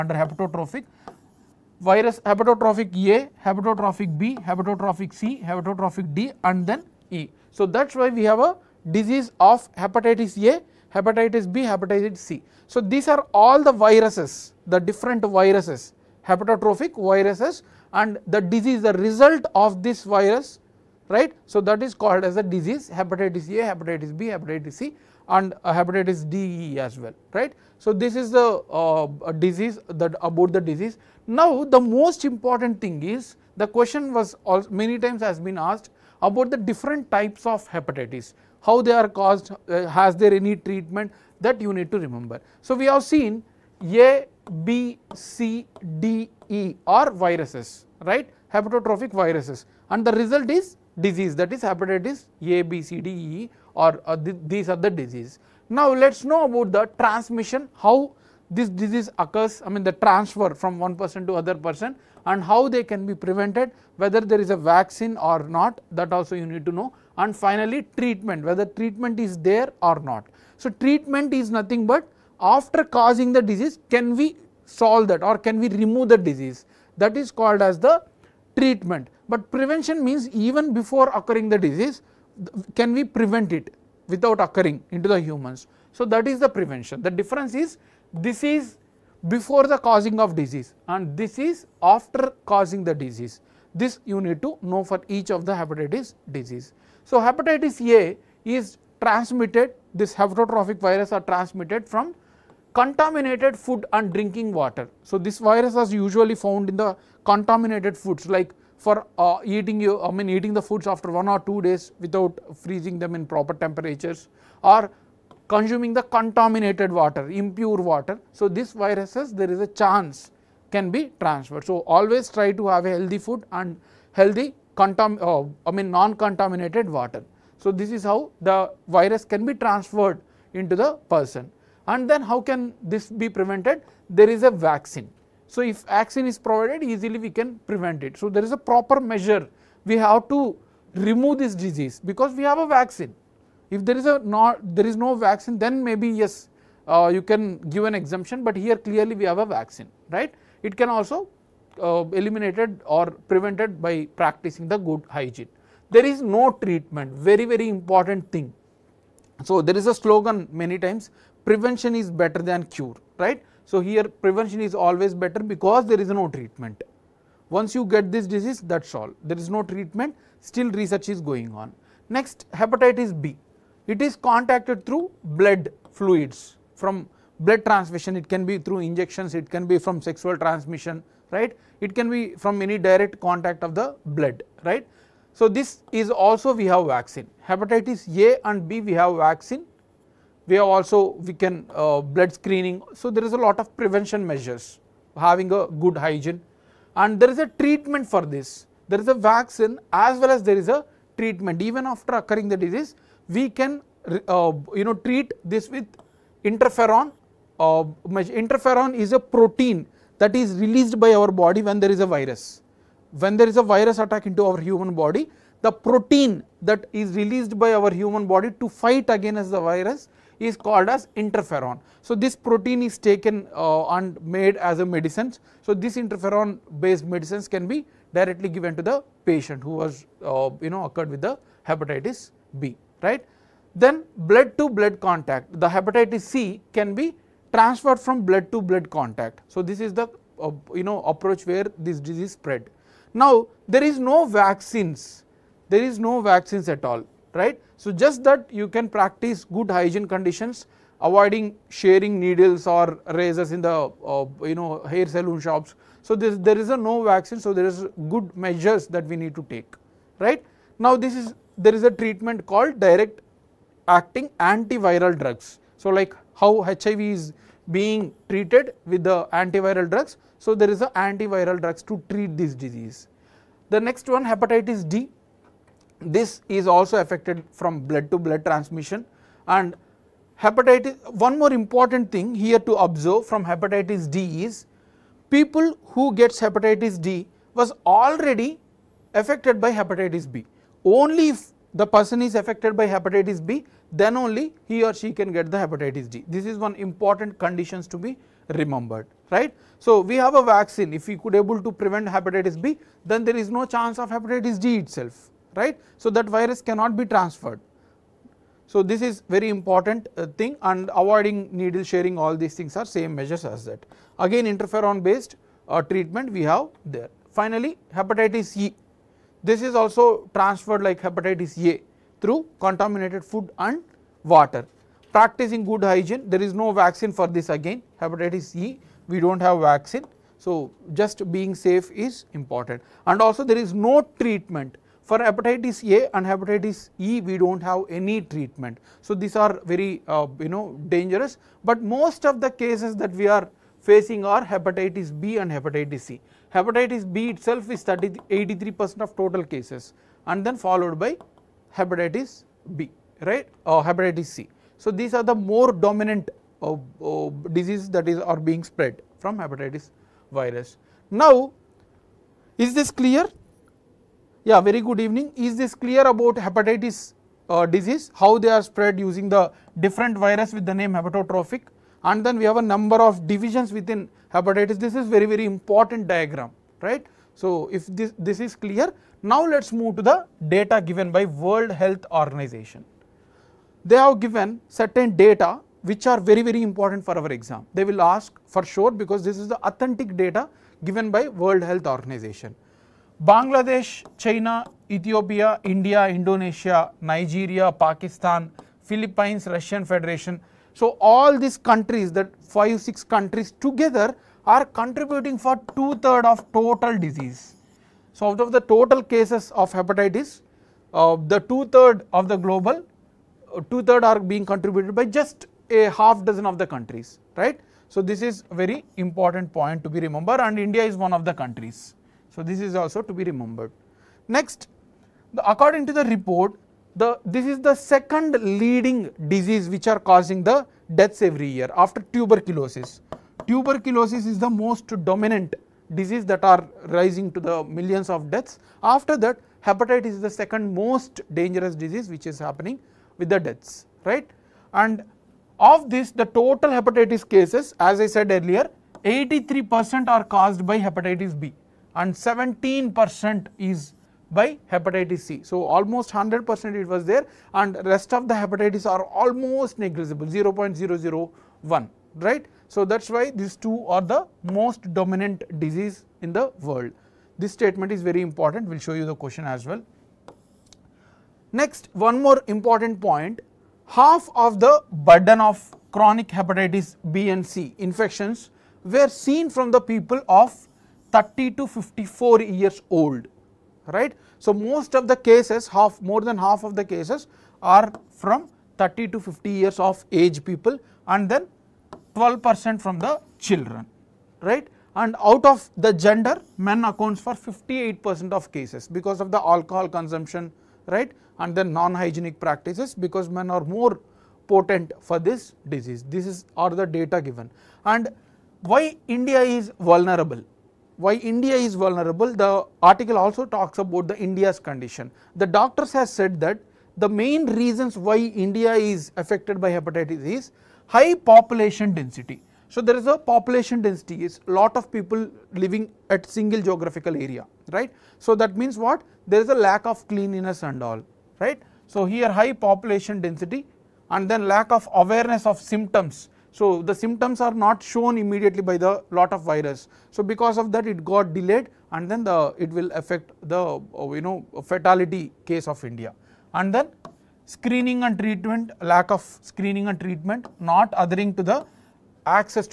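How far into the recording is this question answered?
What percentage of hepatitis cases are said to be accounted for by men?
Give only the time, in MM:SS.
08:17.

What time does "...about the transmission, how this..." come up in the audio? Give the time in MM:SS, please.
00:56.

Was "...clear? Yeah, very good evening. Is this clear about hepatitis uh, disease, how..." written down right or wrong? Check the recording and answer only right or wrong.
right.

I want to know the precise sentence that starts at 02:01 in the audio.
So, always try to have a healthy food and healthy contam uh, I mean non-contaminated water.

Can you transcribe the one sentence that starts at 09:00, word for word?
So, because of that it got delayed and then the it will affect the uh, you know fatality case of India.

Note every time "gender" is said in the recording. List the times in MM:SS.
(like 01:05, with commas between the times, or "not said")
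08:15.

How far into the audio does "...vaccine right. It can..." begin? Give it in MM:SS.
02:29.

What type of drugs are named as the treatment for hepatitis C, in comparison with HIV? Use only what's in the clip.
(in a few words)
Direct acting antiviral drugs.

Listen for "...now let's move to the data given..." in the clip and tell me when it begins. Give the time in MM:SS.
06:19.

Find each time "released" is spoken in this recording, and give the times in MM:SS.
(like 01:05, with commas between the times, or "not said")
03:30, 03:37.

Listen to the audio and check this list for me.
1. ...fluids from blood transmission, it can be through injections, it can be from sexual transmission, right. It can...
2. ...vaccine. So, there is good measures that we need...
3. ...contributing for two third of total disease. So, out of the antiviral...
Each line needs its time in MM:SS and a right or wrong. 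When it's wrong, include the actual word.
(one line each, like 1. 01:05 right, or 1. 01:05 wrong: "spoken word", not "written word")
1. 02:55 right
2. 04:17 right
3. 06:44 wrong: "total", not "antiviral".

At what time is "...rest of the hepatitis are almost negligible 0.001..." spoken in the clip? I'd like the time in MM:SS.
07:37.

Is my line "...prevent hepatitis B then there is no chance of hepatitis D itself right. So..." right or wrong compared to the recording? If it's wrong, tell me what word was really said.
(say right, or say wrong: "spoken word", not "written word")
right.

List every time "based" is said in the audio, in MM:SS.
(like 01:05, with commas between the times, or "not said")
03:46, 05:15.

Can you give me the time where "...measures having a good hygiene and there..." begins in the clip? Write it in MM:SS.
03:14.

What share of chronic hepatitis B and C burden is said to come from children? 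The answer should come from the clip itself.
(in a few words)
12 percent.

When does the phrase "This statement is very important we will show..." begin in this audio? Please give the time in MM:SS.
07:47.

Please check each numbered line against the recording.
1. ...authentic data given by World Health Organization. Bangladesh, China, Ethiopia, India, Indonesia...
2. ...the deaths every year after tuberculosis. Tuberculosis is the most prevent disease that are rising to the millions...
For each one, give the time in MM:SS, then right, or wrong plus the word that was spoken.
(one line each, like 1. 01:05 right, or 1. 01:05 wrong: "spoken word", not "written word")
1. 06:29 right
2. 07:10 wrong: "dominant", not "prevent".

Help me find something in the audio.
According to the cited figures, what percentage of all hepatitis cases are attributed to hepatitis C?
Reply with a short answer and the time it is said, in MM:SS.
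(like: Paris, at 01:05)
17 percent, at 07:32.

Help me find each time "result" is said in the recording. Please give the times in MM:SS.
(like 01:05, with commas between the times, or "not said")
00:18, 00:50.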